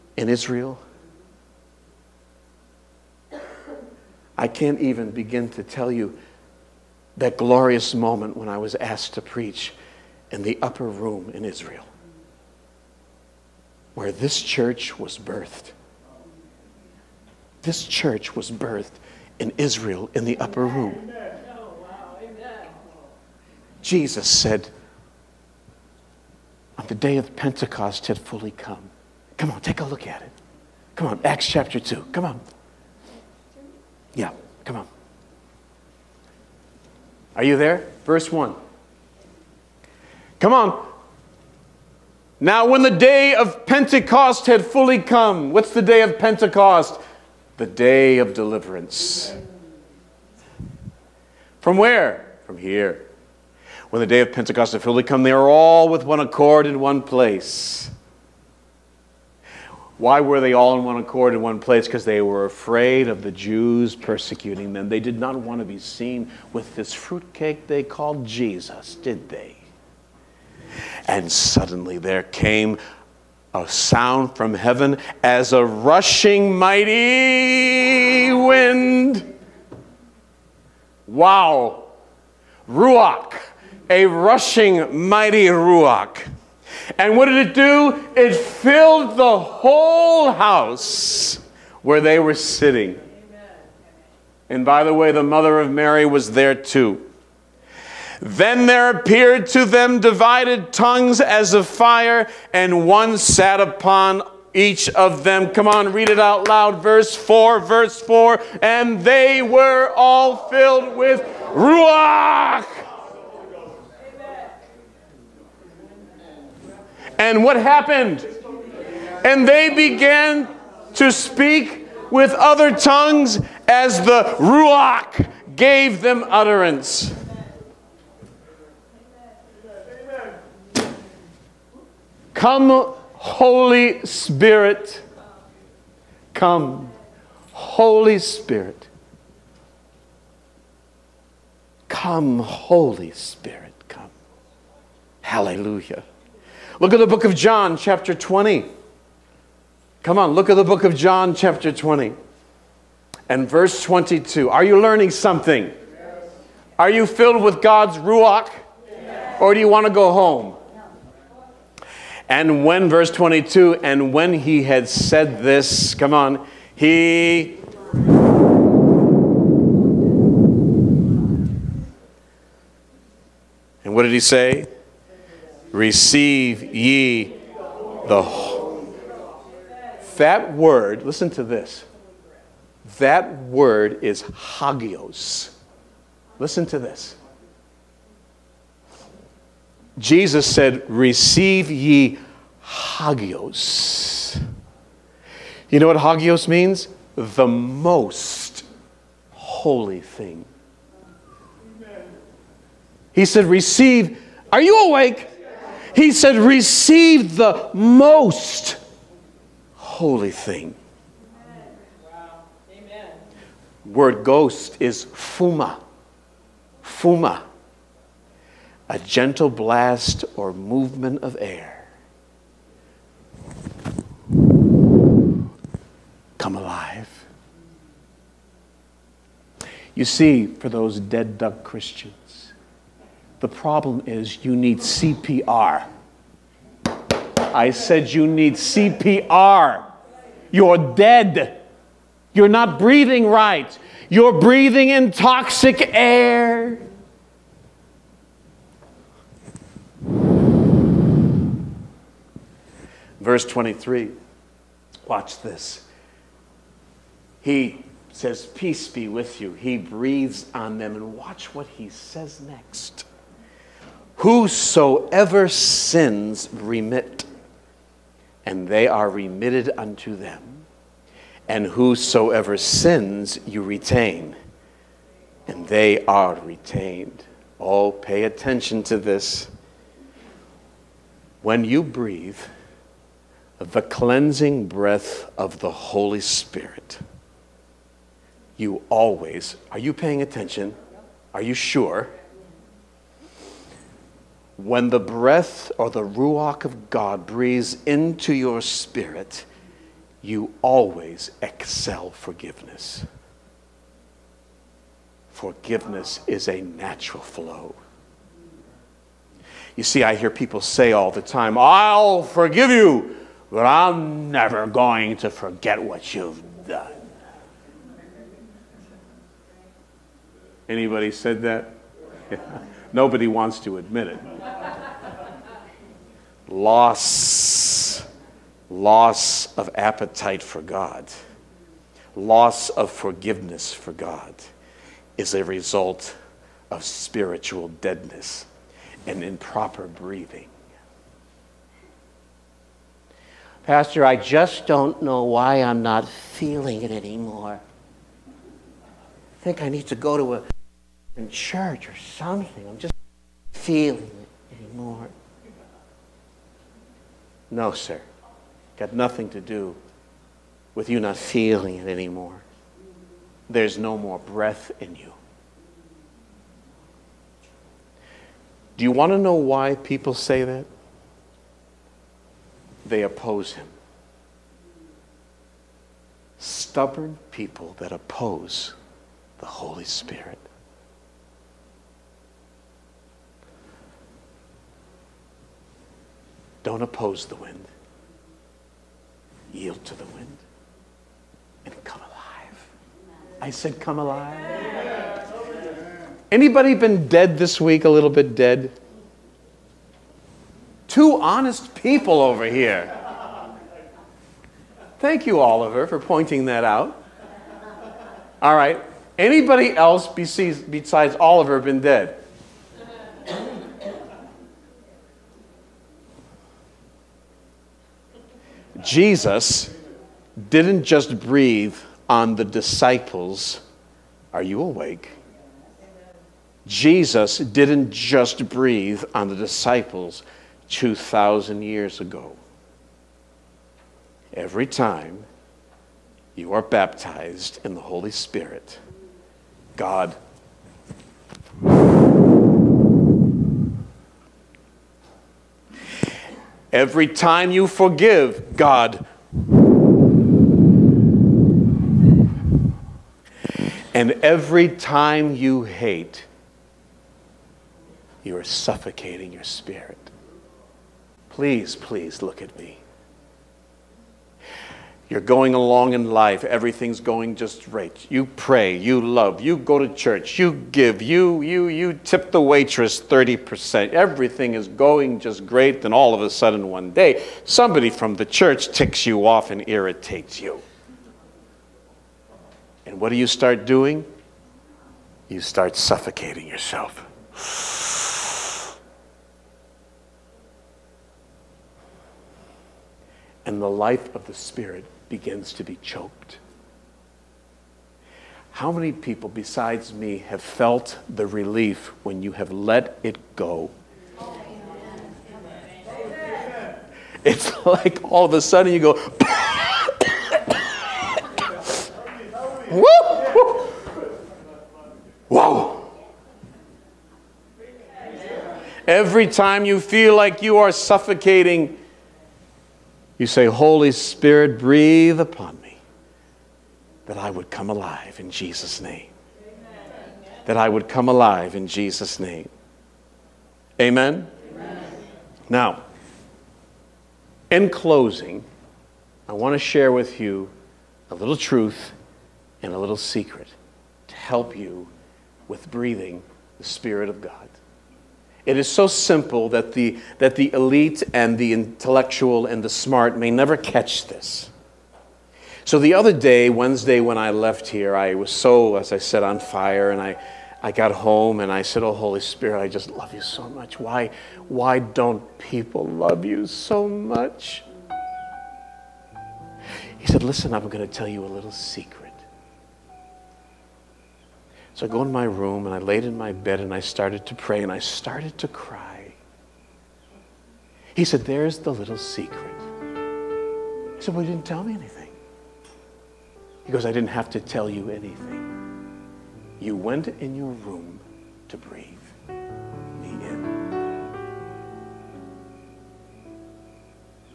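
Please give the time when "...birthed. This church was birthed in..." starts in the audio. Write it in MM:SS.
00:15.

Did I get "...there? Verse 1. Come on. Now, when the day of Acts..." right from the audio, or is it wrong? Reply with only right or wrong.
wrong.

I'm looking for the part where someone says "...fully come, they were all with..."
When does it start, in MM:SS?
00:54.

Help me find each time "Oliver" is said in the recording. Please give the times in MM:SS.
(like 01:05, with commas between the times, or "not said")
06:45, 06:51.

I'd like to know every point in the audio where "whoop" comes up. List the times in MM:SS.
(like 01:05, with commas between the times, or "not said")
08:32.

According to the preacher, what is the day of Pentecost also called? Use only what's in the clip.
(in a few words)
The day of deliverance.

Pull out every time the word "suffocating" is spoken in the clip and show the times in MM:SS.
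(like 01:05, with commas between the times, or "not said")
07:38, 08:05, 08:40.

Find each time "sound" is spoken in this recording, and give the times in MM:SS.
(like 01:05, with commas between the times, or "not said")
01:13.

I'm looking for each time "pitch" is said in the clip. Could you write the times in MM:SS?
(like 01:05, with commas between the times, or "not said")
not said.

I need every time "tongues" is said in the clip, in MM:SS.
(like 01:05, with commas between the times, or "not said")
01:40, 02:02.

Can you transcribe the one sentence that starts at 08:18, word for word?
How many people besides me have felt the relief when you have let it go?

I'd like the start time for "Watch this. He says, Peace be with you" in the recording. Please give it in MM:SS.
04:15.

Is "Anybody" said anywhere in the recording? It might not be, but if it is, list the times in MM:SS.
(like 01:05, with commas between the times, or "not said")
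05:20, 06:36, 06:49.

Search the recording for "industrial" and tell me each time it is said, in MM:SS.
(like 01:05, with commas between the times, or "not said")
not said.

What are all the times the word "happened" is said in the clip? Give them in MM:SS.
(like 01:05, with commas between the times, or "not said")
01:57.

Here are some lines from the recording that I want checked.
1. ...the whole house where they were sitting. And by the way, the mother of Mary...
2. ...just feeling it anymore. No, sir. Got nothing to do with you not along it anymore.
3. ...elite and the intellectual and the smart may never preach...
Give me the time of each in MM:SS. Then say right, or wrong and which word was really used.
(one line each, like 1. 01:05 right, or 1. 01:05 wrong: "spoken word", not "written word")
1. 01:29 right
2. 05:52 wrong: "feeling", not "along"
3. 09:10 wrong: "catch", not "preach".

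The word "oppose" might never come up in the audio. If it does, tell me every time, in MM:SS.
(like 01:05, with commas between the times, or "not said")
06:13, 06:17, 06:26.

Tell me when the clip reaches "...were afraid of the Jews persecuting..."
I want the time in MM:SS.
01:02.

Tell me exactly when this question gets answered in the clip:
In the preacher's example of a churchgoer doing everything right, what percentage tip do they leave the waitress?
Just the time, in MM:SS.
07:53.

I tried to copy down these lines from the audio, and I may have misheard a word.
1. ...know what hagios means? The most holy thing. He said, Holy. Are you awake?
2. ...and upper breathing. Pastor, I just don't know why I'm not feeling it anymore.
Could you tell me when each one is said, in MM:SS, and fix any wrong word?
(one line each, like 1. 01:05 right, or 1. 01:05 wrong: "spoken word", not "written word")
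1. 03:15 wrong: "Receive", not "Holy"
2. 05:39 wrong: "improper", not "upper".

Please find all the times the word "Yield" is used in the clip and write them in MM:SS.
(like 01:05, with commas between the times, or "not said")
06:29.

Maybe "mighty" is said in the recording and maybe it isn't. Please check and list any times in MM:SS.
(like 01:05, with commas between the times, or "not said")
01:16, 01:25.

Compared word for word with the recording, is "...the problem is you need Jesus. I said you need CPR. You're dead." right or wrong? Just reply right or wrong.
wrong.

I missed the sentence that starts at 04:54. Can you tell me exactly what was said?
When the breath or the Ruach of God breathes into your spirit, you always excel forgiveness.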